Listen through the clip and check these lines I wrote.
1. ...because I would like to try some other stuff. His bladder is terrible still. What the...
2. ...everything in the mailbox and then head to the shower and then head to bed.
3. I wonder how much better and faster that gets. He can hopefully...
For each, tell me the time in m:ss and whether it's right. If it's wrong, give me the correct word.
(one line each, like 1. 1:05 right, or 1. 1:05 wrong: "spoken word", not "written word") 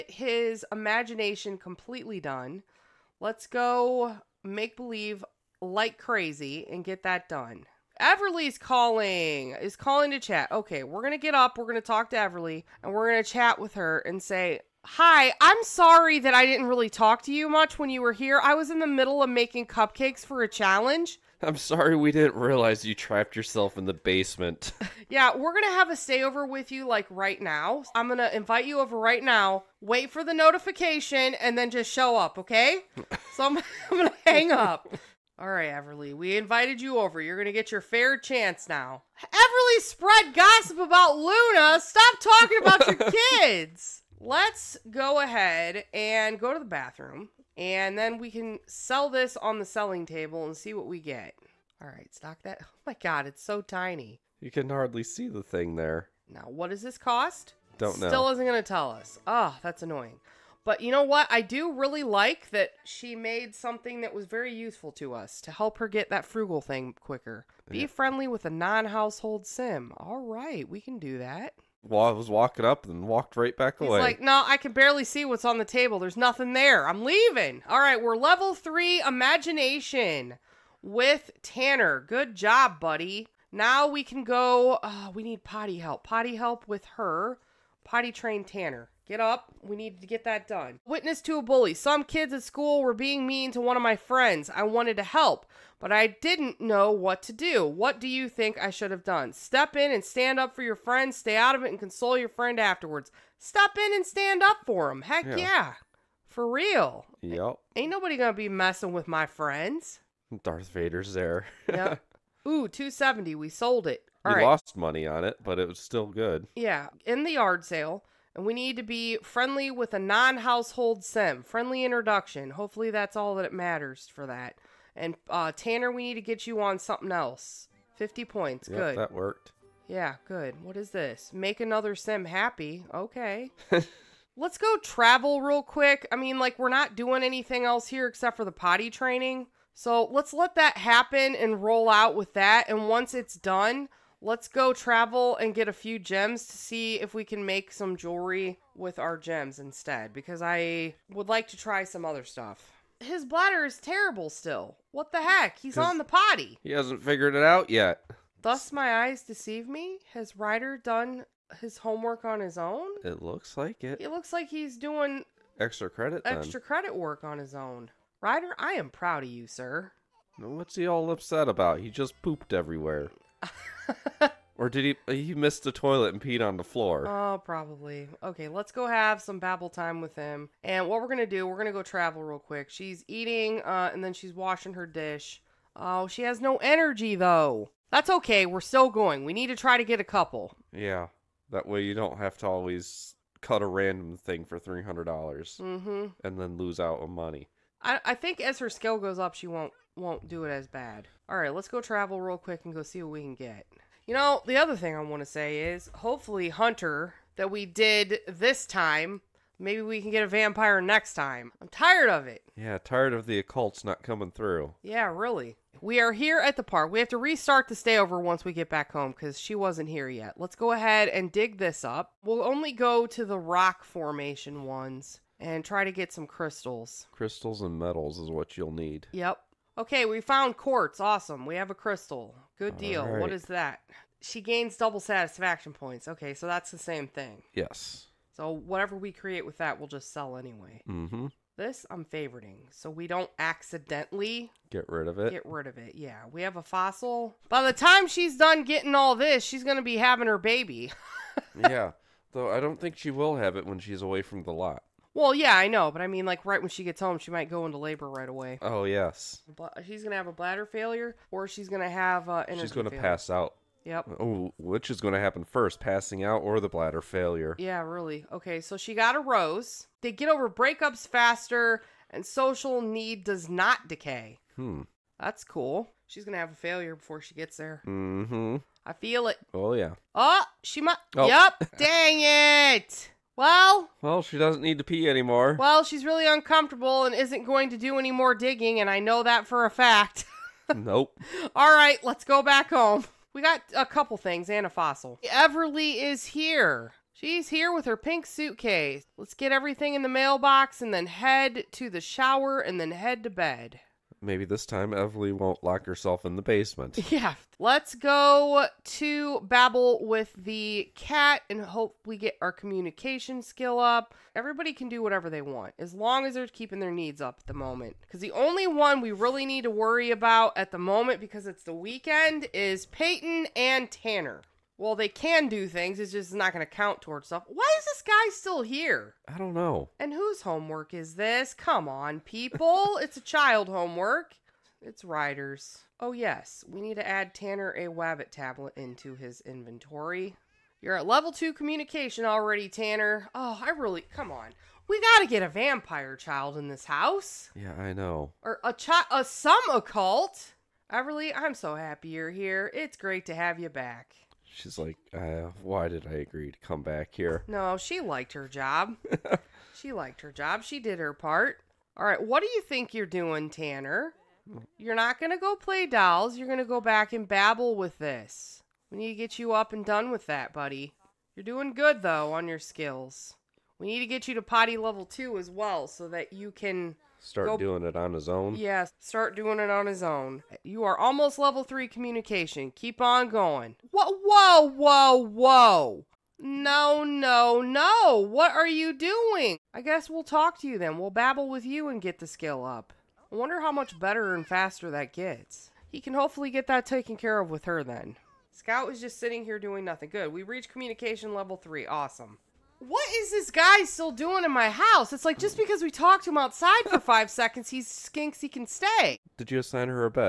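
1. 2:30 right
2. 4:59 right
3. 6:33 right.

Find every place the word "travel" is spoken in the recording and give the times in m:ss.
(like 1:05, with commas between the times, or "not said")
2:14, 2:24, 3:01, 3:21.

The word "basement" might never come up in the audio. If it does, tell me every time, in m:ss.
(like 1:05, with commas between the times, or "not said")
0:23, 5:06.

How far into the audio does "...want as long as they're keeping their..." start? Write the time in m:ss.
5:15.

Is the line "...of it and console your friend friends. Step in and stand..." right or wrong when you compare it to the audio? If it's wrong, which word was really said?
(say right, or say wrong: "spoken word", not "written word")
wrong: "afterwards", not "friends".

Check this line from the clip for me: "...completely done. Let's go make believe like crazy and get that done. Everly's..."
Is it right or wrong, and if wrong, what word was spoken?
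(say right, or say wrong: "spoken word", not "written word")
right.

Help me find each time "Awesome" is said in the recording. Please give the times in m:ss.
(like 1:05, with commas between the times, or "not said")
3:50, 6:41.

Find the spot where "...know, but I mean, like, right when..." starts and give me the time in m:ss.
4:15.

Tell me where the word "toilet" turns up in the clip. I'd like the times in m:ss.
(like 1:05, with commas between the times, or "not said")
2:55.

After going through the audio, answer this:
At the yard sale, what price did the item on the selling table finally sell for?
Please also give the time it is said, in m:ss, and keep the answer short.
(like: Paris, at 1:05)
270, at 1:52.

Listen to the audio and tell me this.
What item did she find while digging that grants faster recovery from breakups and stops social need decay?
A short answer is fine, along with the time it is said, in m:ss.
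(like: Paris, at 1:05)
A rose, at 4:29.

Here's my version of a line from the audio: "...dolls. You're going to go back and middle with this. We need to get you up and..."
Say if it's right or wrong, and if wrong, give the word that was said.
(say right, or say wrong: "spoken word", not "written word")
wrong: "babble", not "middle".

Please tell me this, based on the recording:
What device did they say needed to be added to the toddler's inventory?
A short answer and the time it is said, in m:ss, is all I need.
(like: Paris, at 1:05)
Wabbit tablet, at 5:37.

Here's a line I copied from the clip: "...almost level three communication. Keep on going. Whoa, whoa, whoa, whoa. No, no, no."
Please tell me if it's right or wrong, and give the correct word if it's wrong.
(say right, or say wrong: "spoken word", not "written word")
right.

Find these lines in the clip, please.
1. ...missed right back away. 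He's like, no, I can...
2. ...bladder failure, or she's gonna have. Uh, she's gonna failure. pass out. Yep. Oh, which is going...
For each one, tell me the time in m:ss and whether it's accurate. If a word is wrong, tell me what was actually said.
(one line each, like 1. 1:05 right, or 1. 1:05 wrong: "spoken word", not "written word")
1. 1:13 wrong: "walked", not "missed"
2. 4:20 right.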